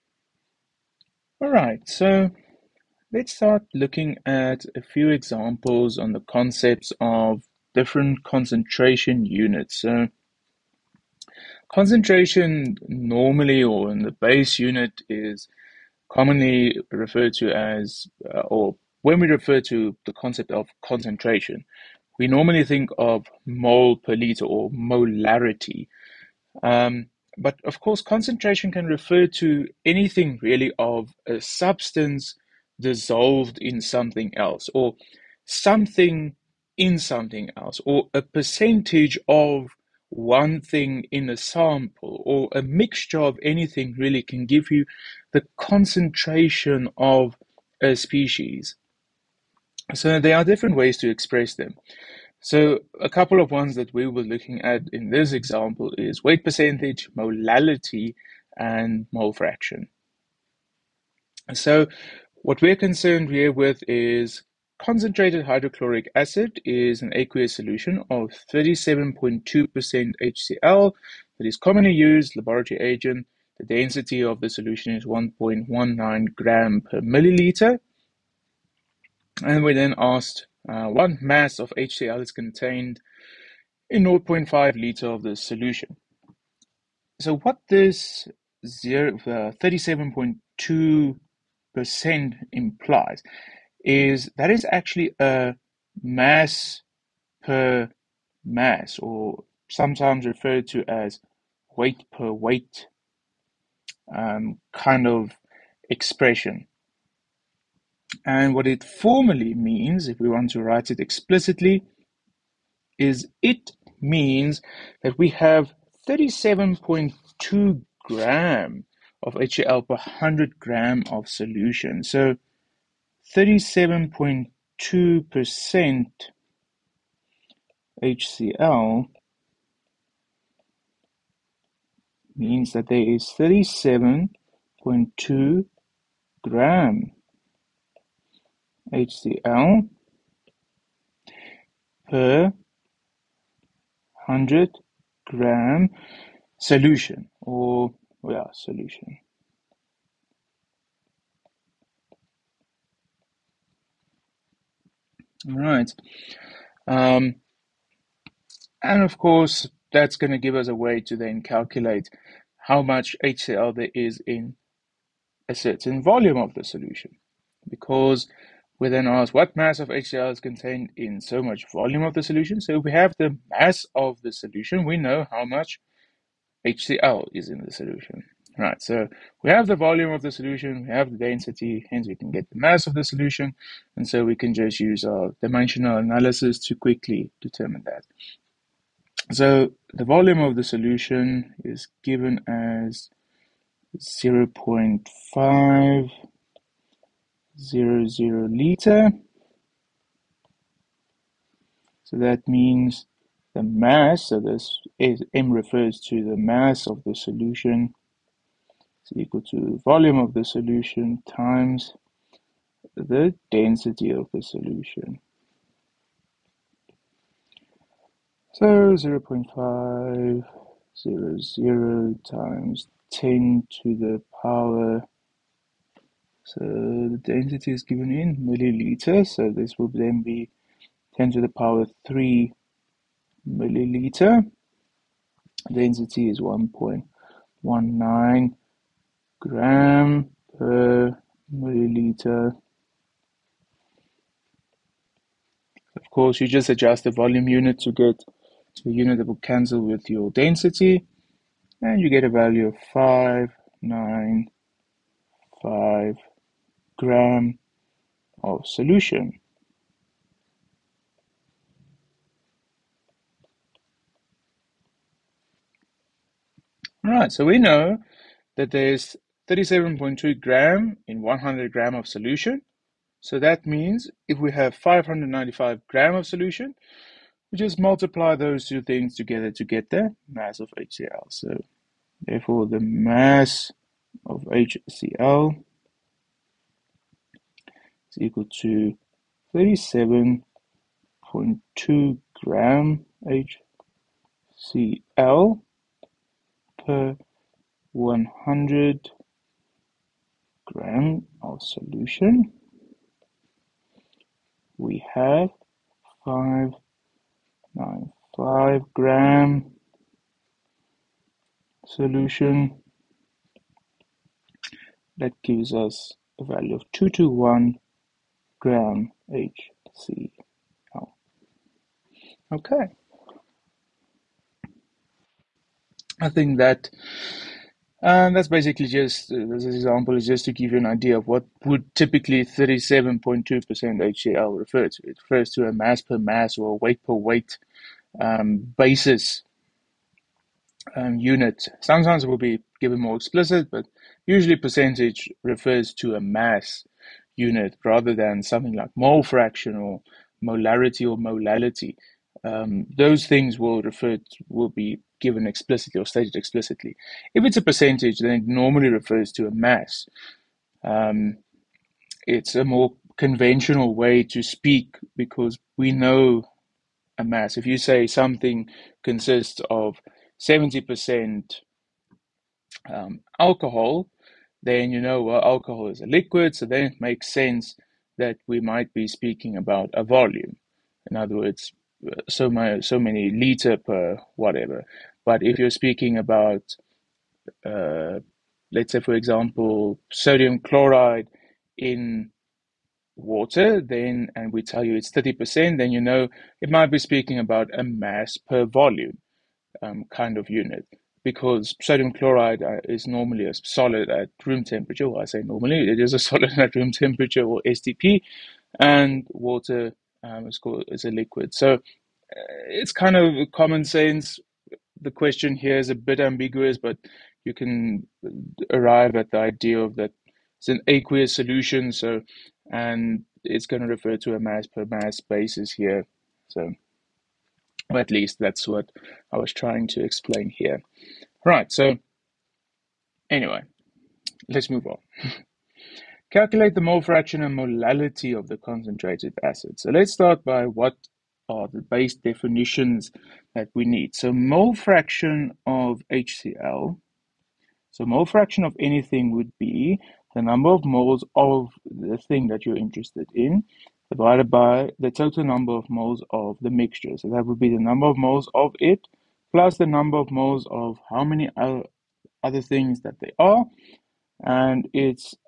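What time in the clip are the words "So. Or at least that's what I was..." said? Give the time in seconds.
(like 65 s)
426 s.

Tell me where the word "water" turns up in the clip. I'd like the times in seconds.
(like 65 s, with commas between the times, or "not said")
393 s, 409 s.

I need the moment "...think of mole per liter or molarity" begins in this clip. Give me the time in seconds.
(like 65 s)
22 s.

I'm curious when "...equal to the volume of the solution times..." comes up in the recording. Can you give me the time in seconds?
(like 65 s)
209 s.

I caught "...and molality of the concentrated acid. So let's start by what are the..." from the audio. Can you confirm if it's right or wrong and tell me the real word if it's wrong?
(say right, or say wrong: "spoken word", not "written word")
right.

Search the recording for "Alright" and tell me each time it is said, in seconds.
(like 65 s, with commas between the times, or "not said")
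1 s.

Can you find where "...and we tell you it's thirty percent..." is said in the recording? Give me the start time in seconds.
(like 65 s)
394 s.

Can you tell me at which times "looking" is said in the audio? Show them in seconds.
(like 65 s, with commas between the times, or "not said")
3 s, 54 s.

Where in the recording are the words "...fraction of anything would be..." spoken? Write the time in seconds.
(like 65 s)
448 s.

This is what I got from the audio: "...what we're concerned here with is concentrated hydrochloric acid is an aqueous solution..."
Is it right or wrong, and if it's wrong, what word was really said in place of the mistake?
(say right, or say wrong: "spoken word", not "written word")
right.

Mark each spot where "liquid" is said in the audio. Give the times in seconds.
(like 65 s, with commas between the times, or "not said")
376 s, 411 s.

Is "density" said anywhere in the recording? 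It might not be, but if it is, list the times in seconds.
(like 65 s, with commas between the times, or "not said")
73 s, 181 s, 213 s, 227 s, 235 s, 250 s.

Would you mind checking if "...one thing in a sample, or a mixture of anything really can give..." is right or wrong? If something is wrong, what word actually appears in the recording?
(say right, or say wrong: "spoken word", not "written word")
right.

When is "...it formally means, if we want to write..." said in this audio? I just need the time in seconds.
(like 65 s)
108 s.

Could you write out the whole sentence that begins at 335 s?
It refers to a mass per mass or weight per weight um, basis um, unit.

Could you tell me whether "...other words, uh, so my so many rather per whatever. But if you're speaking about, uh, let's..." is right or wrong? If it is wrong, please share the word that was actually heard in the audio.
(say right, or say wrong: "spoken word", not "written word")
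wrong: "liter", not "rather".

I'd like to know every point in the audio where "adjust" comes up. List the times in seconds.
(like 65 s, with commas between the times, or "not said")
246 s.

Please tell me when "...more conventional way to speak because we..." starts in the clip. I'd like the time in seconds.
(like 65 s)
362 s.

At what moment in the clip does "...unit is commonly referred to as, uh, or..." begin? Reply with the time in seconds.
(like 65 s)
14 s.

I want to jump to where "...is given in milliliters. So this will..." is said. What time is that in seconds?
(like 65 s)
227 s.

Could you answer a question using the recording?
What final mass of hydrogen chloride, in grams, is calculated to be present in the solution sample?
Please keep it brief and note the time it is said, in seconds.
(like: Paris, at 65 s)
221 grams, at 316 s.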